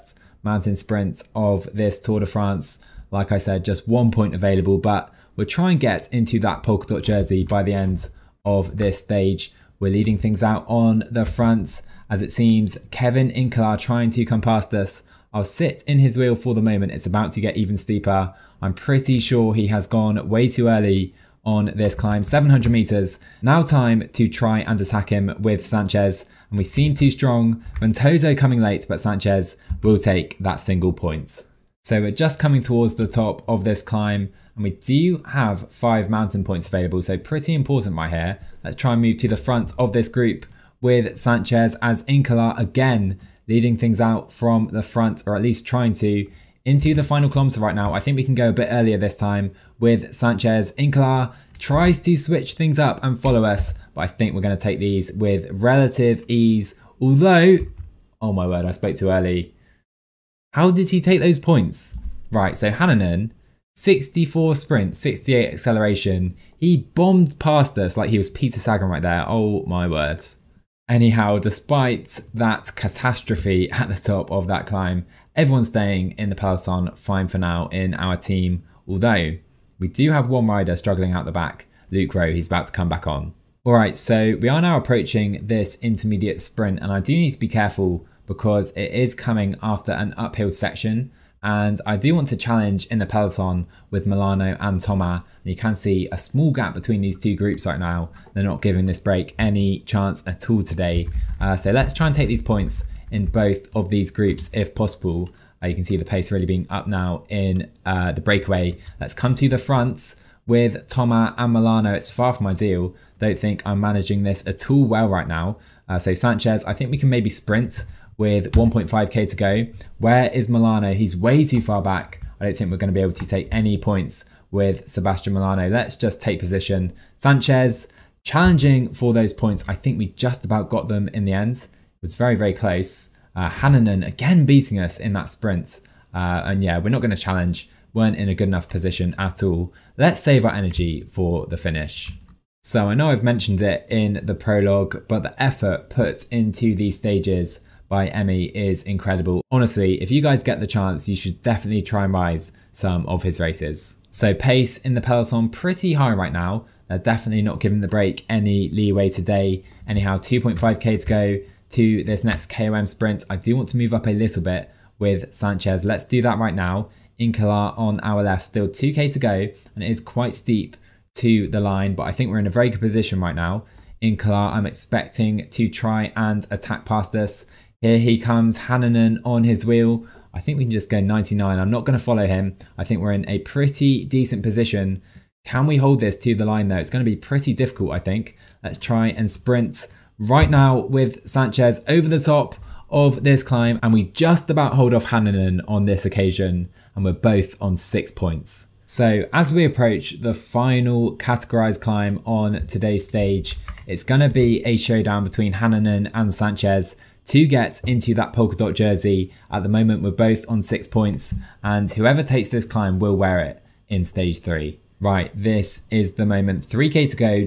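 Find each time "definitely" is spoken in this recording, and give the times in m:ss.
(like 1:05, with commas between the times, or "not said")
2:31, 2:36.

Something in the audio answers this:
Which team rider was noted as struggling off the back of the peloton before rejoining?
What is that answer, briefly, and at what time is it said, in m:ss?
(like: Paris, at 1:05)
Luke Rowe, at 1:21.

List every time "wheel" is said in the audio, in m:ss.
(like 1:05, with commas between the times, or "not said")
0:16, 2:59.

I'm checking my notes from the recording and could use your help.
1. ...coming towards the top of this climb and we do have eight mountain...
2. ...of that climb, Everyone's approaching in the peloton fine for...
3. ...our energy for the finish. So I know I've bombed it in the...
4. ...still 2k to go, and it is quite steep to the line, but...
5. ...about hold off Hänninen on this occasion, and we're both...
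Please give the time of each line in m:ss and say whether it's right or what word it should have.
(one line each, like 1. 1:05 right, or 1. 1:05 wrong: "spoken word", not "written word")
1. 0:32 wrong: "five", not "eight"
2. 1:14 wrong: "staying", not "approaching"
3. 2:20 wrong: "mentioned", not "bombed"
4. 2:48 right
5. 3:14 right.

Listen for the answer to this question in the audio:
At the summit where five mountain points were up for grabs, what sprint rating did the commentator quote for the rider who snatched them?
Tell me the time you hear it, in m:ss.
1:03.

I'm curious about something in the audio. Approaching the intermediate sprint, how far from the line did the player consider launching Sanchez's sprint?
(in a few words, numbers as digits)
1.5k.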